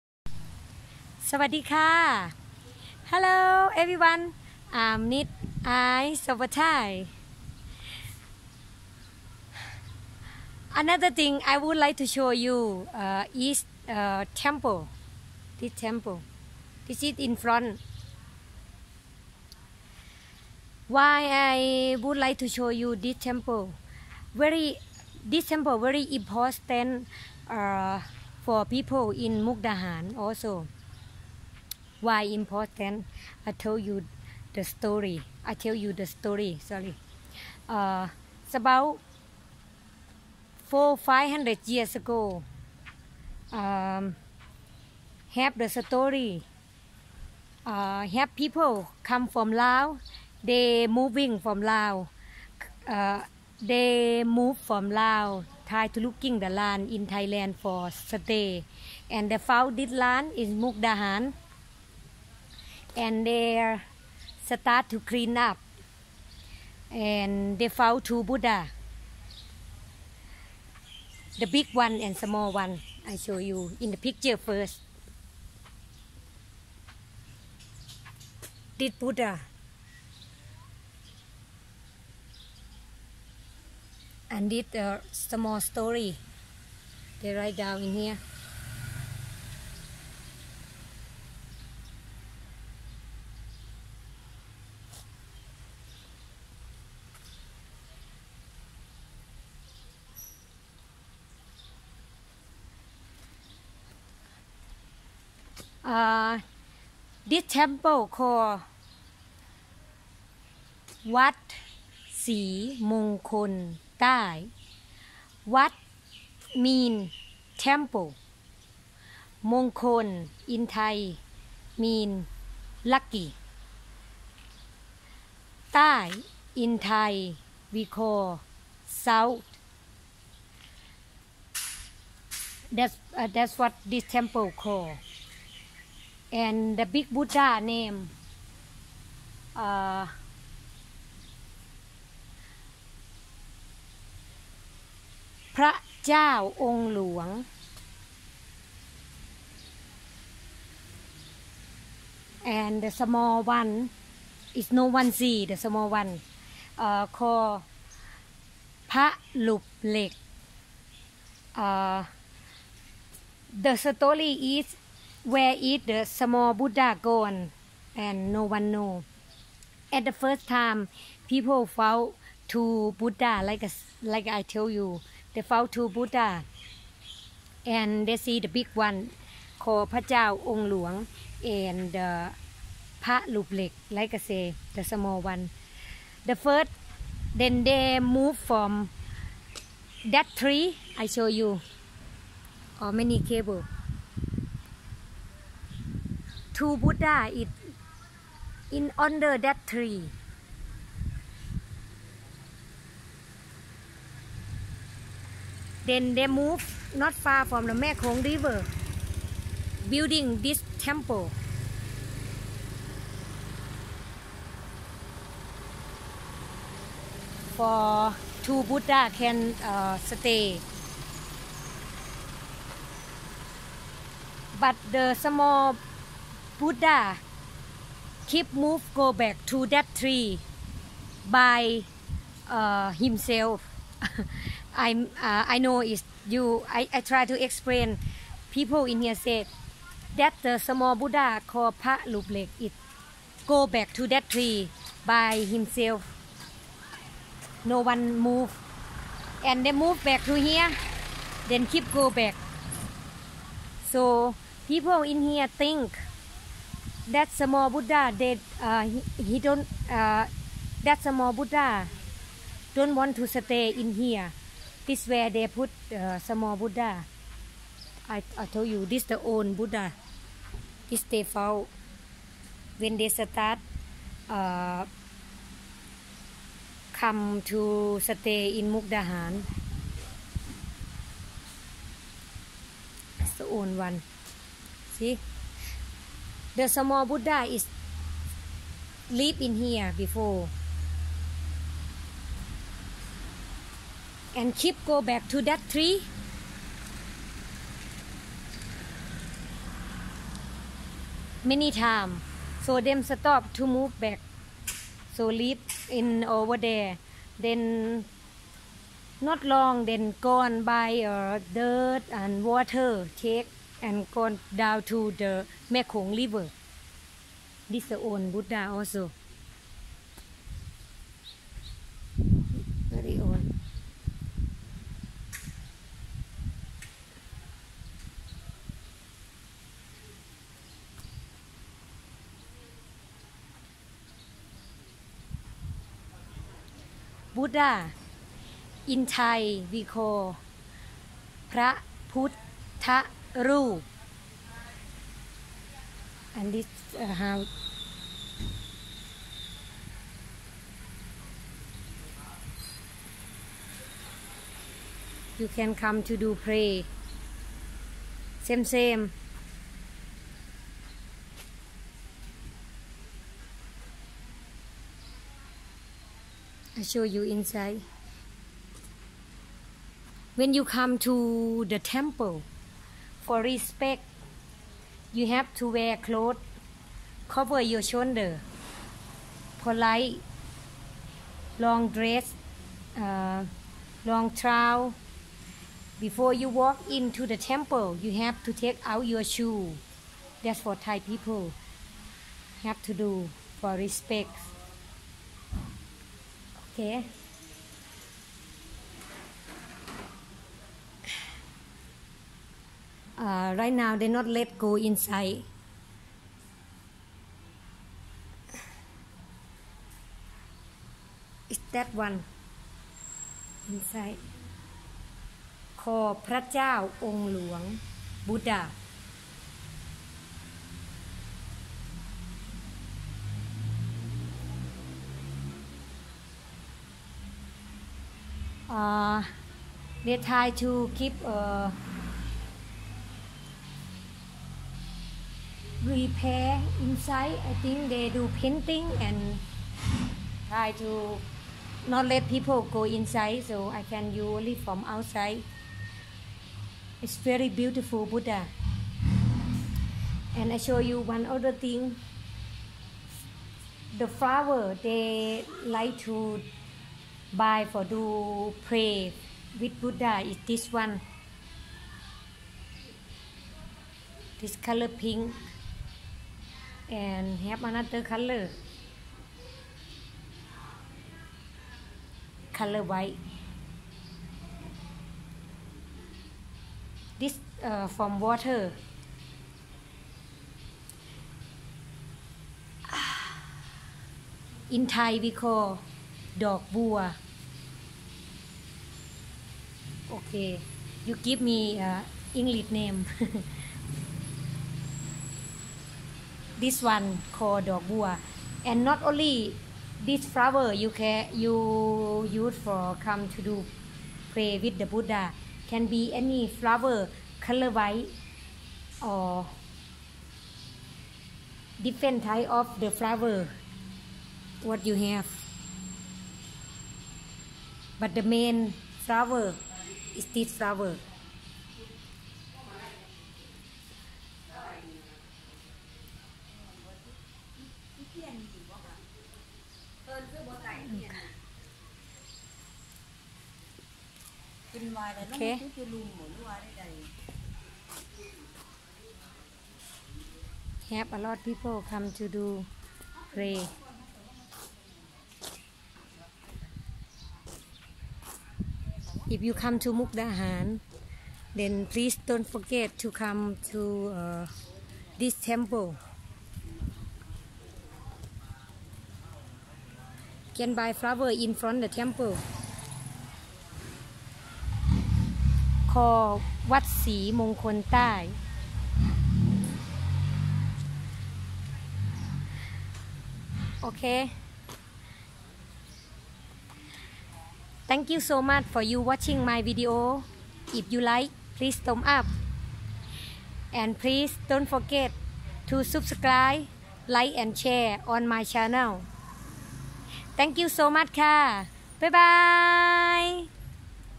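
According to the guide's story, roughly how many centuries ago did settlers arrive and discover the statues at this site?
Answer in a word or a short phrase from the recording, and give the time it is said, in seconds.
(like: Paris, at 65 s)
400-500 years ago, at 40 s.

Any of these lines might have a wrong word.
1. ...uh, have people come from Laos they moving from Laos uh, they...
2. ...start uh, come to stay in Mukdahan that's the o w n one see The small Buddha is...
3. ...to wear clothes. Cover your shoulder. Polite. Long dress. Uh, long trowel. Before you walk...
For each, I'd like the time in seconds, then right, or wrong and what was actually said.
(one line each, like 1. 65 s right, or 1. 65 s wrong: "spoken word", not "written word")
1. 47 s right
2. 273 s right
3. 375 s right.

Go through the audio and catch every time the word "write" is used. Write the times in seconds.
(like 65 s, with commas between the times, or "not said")
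87 s.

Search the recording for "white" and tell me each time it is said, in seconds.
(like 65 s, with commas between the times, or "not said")
472 s, 507 s.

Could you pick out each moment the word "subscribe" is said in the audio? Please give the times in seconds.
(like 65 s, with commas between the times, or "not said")
585 s.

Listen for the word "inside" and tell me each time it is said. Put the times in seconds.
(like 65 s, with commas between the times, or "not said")
367 s, 404 s, 413 s, 436 s, 442 s.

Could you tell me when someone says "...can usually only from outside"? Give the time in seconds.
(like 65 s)
443 s.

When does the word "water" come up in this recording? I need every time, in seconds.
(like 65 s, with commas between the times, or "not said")
312 s, 478 s.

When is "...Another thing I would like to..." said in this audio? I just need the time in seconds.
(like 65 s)
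10 s.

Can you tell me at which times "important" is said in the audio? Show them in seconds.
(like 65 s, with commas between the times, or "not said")
26 s, 32 s.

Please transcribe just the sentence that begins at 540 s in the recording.
Have a lot of people come to do pray.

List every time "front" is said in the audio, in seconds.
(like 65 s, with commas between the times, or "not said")
17 s, 561 s.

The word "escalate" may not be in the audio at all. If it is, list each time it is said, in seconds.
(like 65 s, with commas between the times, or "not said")
not said.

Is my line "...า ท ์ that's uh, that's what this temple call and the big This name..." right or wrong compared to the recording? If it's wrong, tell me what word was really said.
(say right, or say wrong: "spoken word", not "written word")
wrong: "Buddha", not "This".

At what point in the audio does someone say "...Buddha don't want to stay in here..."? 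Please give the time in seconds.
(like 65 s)
261 s.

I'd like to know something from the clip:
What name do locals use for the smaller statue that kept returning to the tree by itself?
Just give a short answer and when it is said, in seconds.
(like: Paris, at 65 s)
Pa Luplek, at 241 s.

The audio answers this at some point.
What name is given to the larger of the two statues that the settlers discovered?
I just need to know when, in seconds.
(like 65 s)
146 s.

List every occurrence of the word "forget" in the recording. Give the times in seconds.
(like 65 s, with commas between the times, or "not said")
552 s, 584 s.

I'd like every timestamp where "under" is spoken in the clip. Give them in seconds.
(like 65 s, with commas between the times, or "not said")
198 s.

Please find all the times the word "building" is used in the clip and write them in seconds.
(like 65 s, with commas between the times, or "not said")
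209 s.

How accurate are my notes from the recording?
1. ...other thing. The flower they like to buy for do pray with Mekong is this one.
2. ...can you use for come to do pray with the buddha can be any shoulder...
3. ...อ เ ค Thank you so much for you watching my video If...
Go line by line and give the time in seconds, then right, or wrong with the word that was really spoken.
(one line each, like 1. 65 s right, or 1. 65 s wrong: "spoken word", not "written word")
1. 451 s wrong: "Buddha", not "Mekong"
2. 500 s wrong: "flower", not "shoulder"
3. 573 s right.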